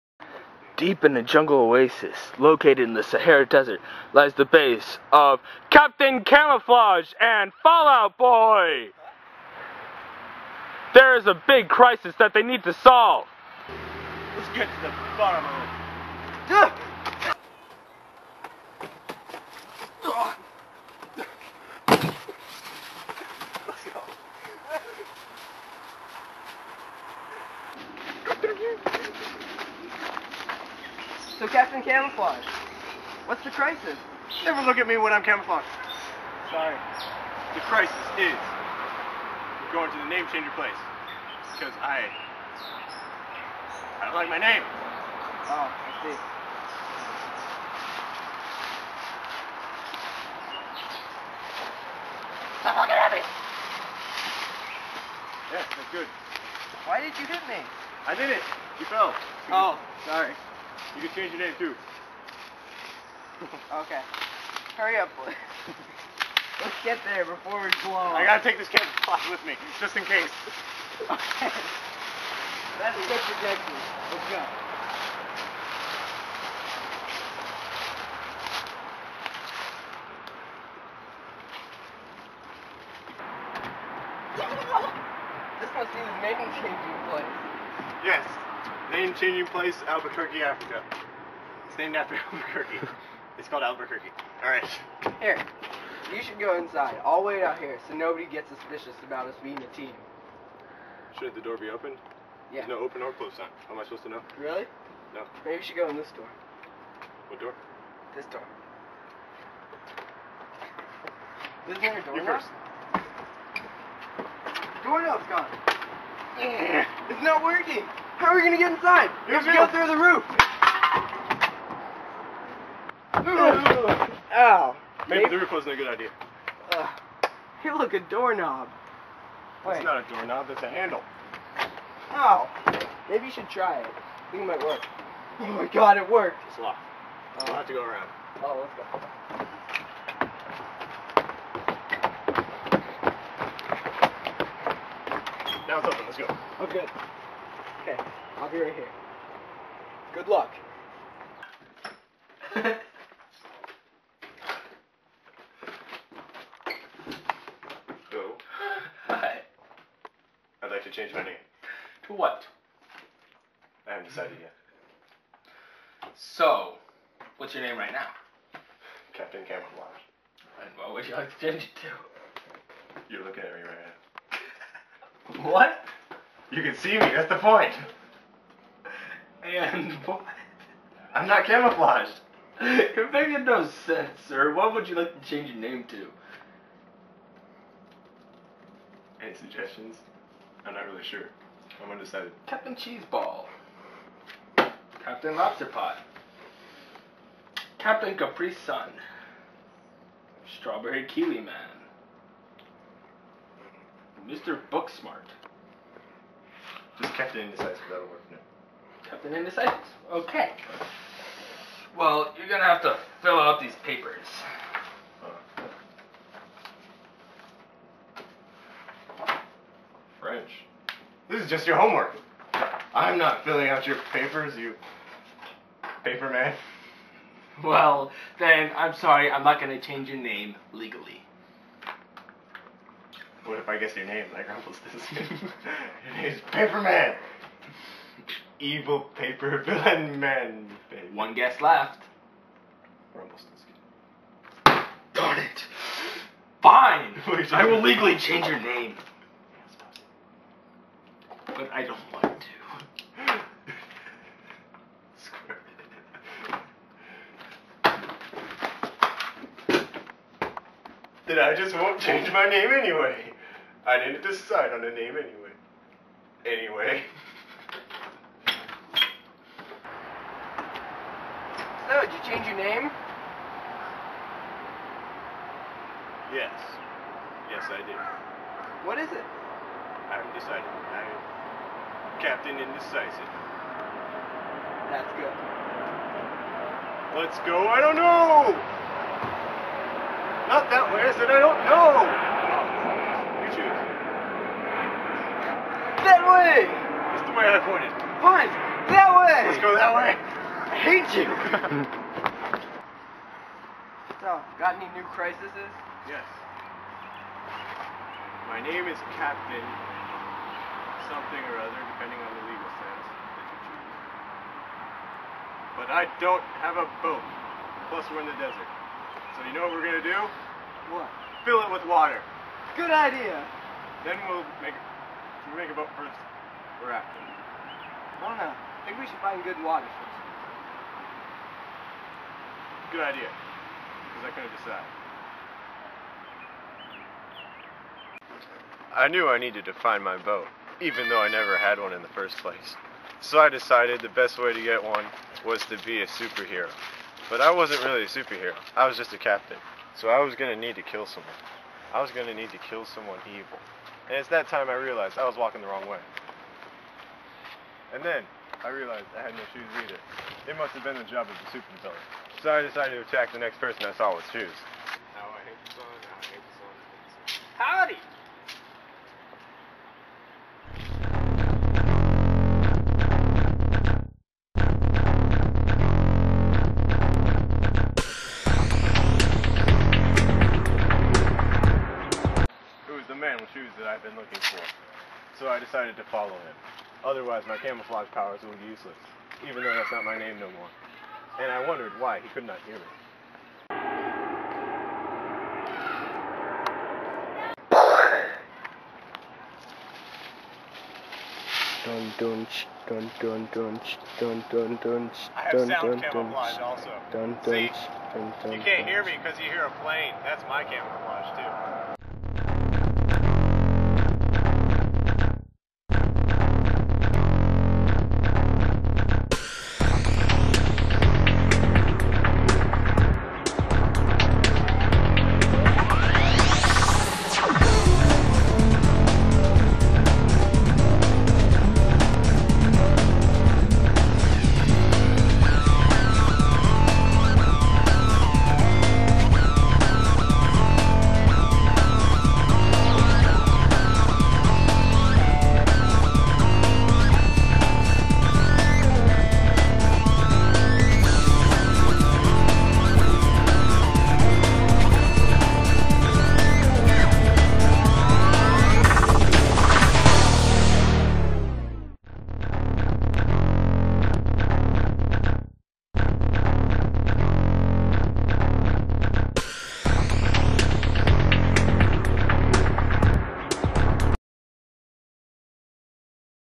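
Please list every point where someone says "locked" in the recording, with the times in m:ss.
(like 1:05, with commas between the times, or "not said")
2:16.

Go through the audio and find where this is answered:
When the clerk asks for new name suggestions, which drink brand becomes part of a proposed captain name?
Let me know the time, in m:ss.
3:17.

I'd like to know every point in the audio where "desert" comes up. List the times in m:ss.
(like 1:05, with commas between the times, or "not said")
0:03, 5:18.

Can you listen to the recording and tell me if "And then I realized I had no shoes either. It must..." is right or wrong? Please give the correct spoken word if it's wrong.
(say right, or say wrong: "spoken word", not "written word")
right.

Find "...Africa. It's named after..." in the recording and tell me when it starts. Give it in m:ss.
1:30.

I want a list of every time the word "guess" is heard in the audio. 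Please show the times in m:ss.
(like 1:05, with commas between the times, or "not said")
3:53, 4:01.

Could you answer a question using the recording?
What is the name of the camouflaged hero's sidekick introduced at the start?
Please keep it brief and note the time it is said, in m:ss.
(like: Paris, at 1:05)
Fallout Boy, at 0:07.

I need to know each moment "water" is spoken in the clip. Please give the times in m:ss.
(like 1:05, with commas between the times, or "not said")
5:21, 5:29.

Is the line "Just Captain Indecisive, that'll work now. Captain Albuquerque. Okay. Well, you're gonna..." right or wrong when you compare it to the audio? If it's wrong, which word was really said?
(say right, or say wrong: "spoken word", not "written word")
wrong: "Indecisive", not "Albuquerque".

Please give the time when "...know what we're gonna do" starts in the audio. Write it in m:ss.
5:19.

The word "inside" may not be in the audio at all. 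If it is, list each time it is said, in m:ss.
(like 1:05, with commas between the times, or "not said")
1:36, 1:58.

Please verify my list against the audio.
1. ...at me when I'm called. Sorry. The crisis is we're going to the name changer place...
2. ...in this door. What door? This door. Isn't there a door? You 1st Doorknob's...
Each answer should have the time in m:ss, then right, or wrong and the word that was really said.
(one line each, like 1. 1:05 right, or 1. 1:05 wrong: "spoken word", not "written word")
1. 0:34 wrong: "camouflaged", not "called"
2. 1:45 right.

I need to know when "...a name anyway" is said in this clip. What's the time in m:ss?
4:24.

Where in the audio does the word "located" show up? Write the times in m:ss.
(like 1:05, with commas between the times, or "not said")
0:02.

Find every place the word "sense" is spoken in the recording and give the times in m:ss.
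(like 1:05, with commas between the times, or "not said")
3:03, 5:12.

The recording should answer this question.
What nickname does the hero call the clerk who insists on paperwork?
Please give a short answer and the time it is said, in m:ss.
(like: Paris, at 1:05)
Paperman, at 3:56.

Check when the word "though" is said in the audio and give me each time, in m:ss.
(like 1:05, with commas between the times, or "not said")
5:41, 6:29.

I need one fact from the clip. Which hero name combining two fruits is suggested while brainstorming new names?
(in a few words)
Strawberry Kiwi Man.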